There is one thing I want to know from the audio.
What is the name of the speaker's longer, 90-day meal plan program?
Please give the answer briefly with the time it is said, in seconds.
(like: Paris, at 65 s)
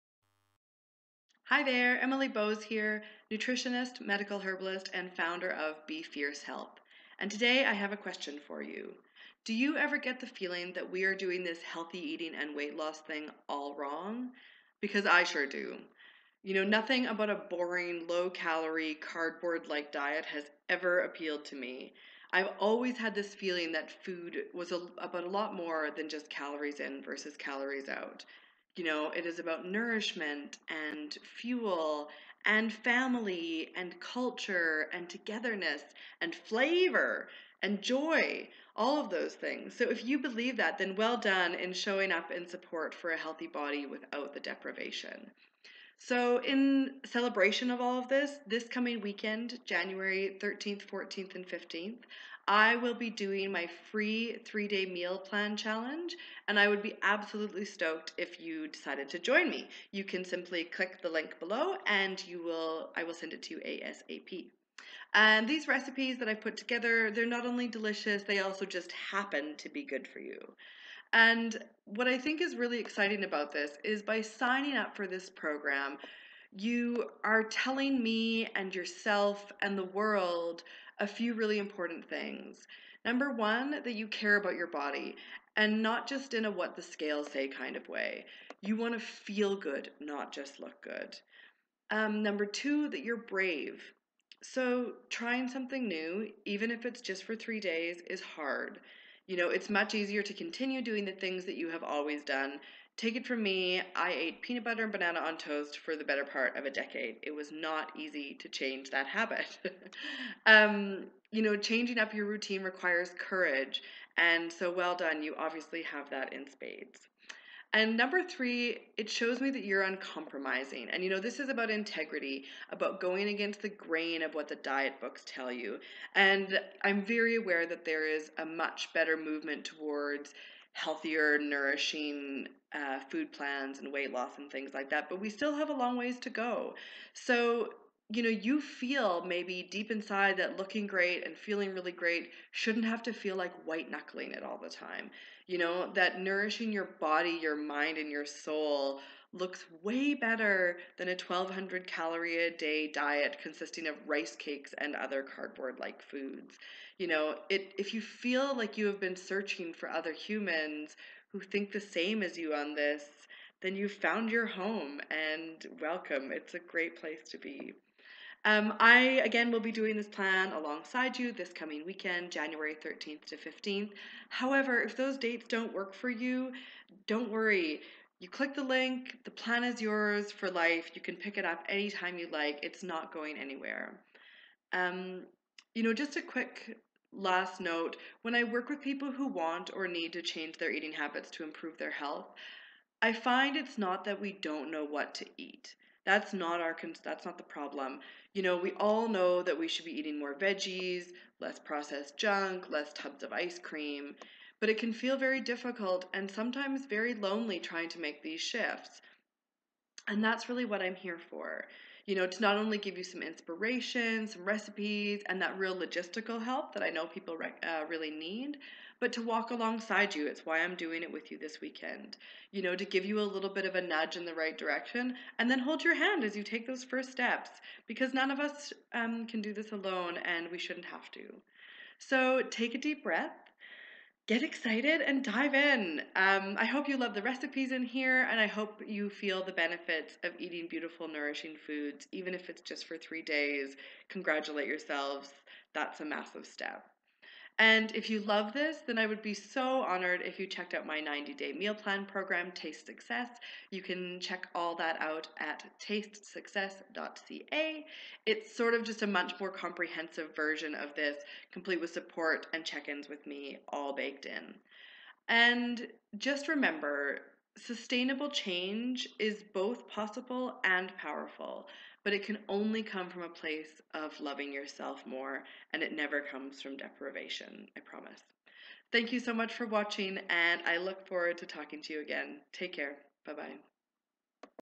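Taste Success, at 252 s.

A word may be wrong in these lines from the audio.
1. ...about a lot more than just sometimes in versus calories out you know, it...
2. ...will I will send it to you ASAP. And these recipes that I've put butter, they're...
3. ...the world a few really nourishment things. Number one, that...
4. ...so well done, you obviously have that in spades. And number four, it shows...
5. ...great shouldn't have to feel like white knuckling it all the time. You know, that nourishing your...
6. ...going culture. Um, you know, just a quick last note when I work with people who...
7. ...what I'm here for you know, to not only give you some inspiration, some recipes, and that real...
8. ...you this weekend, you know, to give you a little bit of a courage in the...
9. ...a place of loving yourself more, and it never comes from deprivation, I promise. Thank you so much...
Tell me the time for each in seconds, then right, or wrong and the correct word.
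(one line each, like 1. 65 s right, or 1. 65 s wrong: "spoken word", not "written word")
1. 24 s wrong: "calories", not "sometimes"
2. 62 s wrong: "together", not "butter"
3. 79 s wrong: "important", not "nourishment"
4. 114 s wrong: "three", not "four"
5. 141 s right
6. 183 s wrong: "anywhere", not "culture"
7. 210 s right
8. 221 s wrong: "nudge", not "courage"
9. 273 s right.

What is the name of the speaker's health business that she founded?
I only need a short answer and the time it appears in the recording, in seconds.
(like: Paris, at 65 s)
Be Fierce Health, at 5 s.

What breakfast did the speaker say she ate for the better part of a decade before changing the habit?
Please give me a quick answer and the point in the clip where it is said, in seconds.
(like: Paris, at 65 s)
peanut butter and banana on toast, at 104 s.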